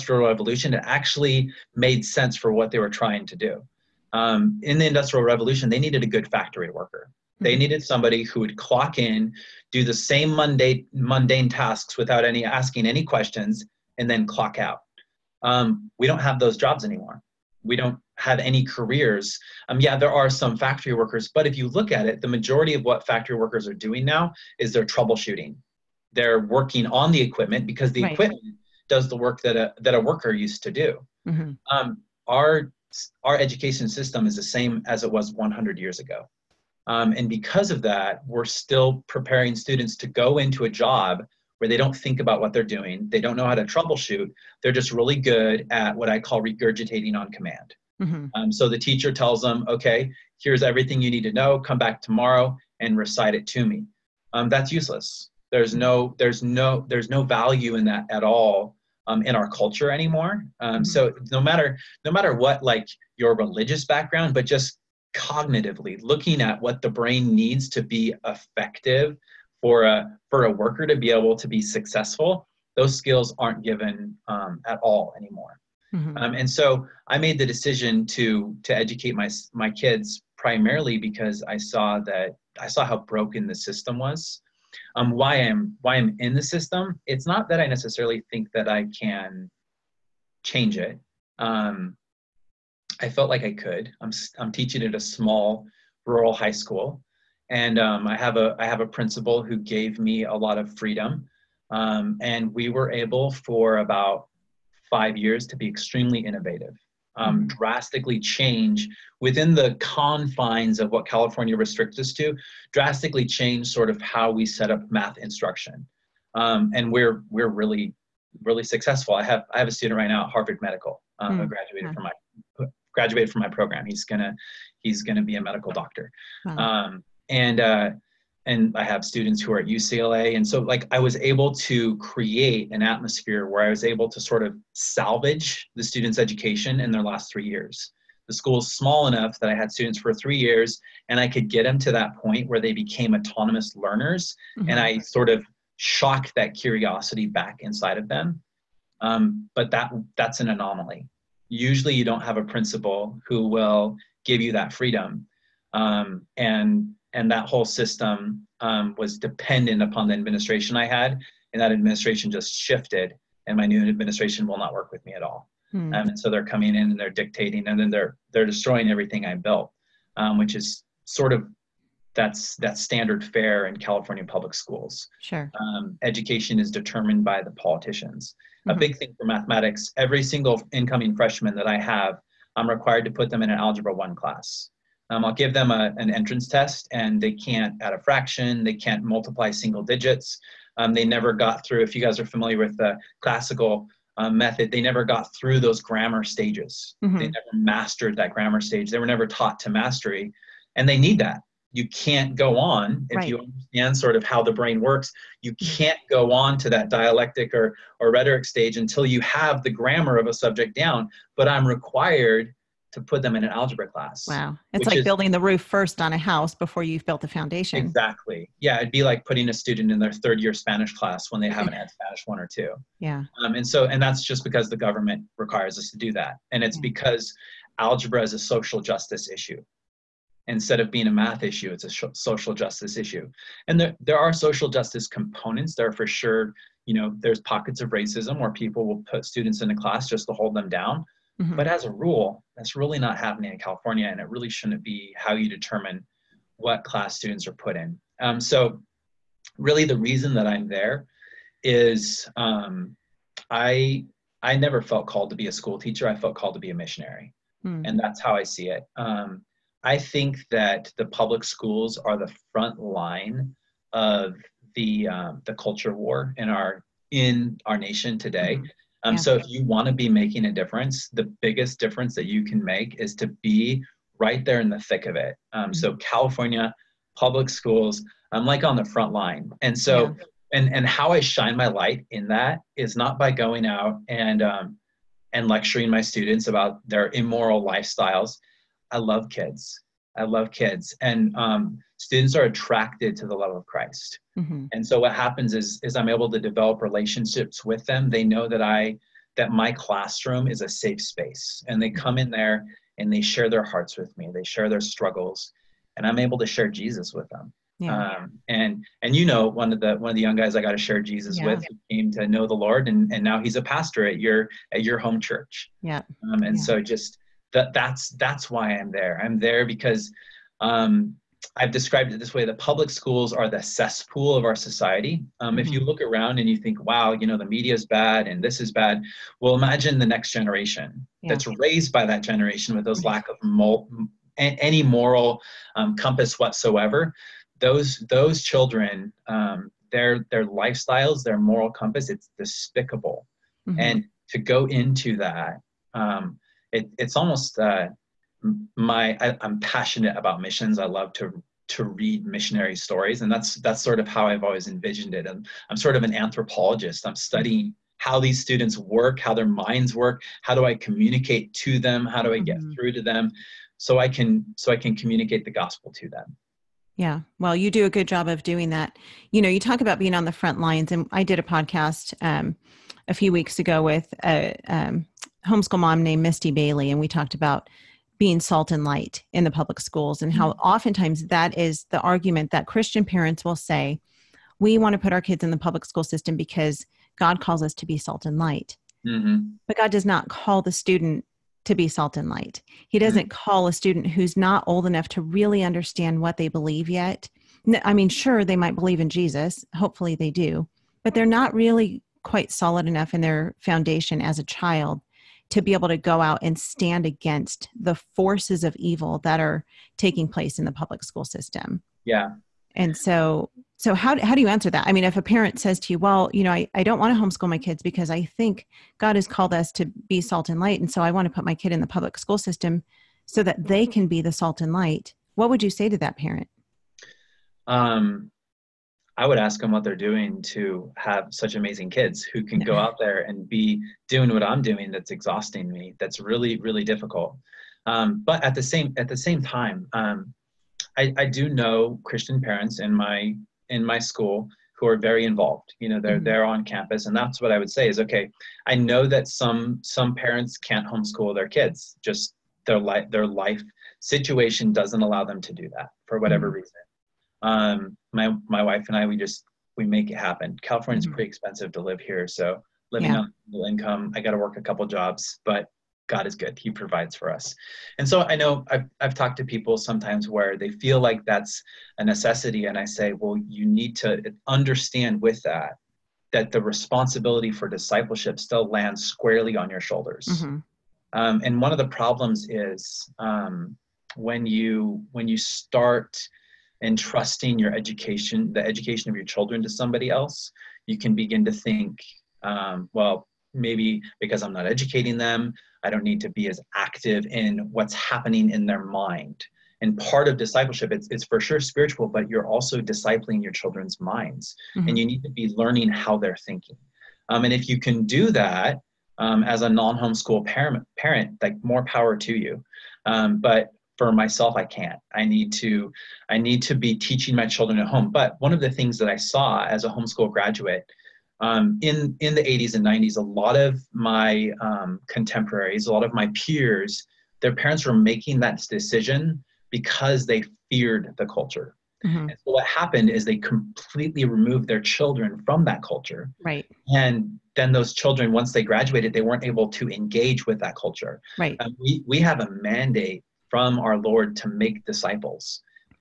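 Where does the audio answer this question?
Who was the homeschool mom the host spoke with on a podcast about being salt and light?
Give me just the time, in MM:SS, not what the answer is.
06:16.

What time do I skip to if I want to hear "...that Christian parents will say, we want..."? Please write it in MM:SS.
06:22.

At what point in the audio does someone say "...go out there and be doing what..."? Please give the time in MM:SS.
07:12.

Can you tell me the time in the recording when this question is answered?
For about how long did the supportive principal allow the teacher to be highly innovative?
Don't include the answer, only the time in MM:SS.
01:44.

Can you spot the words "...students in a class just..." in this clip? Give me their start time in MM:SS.
03:59.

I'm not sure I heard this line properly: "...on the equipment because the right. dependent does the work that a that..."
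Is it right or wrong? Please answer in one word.
wrong.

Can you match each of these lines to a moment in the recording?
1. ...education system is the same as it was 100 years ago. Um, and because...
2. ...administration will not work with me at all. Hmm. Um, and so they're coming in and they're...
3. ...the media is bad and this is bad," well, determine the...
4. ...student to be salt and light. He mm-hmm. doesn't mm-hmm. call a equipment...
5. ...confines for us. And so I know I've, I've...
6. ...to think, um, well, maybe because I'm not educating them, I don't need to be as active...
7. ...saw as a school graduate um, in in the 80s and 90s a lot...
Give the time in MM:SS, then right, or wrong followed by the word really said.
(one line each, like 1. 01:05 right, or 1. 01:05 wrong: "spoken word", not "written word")
1. 00:33 right
2. 02:43 right
3. 05:27 wrong: "imagine", not "determine"
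4. 06:30 wrong: "student", not "equipment"
5. 07:46 wrong: "provides", not "confines"
6. 08:11 right
7. 08:39 wrong: "homeschool", not "school".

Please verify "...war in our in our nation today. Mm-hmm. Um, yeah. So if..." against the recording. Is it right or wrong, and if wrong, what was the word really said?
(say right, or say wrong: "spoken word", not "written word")
right.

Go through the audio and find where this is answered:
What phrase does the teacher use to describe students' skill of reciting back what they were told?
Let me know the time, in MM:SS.
00:46.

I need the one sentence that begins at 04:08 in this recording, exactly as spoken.
Um, so, really, the reason that I'm there is um, I I never felt called to be a school teacher.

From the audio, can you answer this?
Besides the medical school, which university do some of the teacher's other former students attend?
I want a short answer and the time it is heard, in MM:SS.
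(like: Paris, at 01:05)
UCLA, at 02:09.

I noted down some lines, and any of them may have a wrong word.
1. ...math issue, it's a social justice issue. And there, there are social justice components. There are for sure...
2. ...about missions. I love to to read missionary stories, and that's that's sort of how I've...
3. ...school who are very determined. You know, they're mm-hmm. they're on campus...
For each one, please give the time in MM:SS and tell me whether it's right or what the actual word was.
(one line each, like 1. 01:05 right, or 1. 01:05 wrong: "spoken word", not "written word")
1. 03:51 right
2. 05:50 right
3. 07:23 wrong: "involved", not "determined".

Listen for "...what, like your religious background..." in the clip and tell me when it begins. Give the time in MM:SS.
01:02.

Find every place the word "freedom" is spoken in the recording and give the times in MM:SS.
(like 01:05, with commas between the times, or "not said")
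01:40, 02:34.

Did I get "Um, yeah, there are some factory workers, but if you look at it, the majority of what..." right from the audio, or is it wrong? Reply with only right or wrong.
right.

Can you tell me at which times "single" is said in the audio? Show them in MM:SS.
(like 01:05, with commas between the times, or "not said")
03:00, 03:09.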